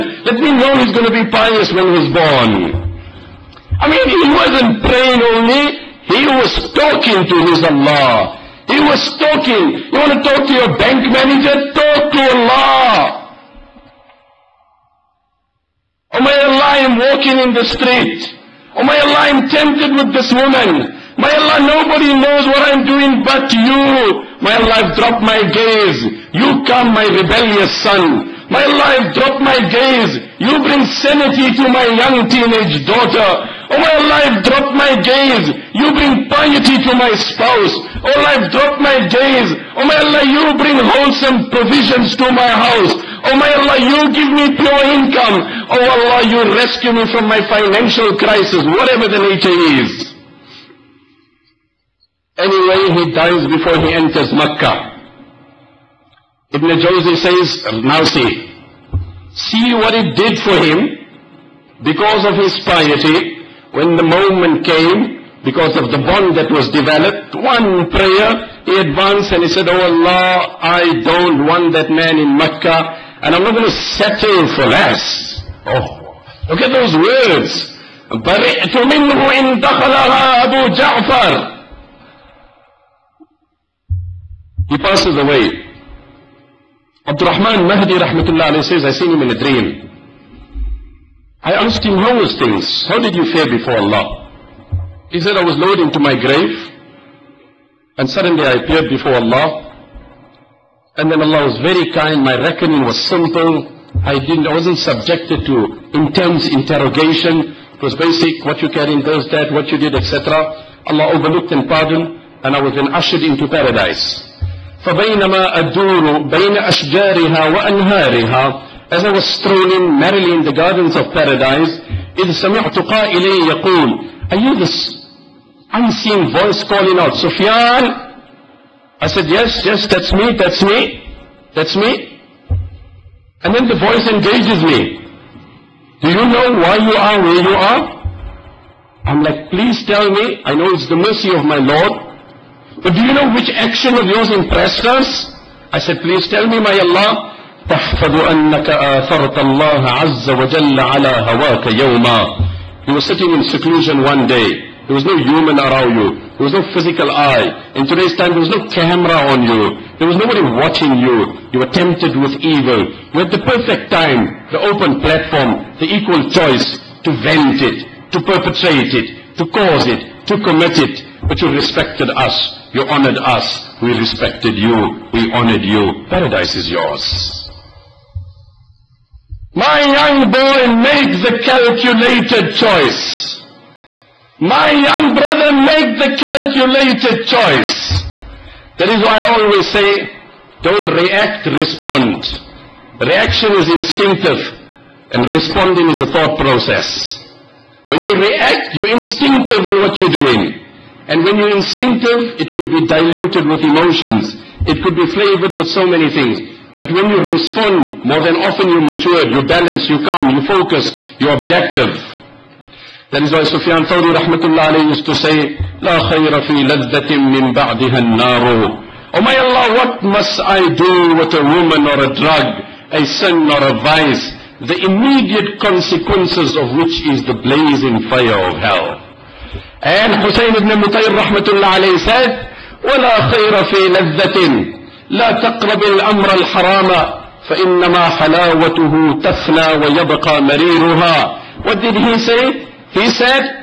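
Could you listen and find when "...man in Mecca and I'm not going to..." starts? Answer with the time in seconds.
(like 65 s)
71 s.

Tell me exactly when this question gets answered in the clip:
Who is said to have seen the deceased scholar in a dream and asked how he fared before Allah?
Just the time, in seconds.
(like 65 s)
87 s.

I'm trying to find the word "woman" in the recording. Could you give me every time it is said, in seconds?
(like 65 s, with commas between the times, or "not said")
20 s, 221 s.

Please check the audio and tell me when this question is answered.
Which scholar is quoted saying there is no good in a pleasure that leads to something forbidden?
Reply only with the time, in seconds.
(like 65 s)
230 s.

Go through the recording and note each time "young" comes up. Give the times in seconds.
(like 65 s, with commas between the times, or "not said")
31 s, 179 s, 184 s.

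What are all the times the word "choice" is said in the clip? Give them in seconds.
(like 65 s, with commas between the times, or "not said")
166 s, 182 s, 187 s.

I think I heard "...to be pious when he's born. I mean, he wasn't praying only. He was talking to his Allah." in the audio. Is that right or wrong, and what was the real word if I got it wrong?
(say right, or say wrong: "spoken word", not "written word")
right.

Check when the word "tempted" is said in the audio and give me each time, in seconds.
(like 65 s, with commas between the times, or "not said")
19 s, 161 s.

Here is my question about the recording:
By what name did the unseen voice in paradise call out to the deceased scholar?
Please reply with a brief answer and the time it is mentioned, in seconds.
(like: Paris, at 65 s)
Sufyan, at 127 s.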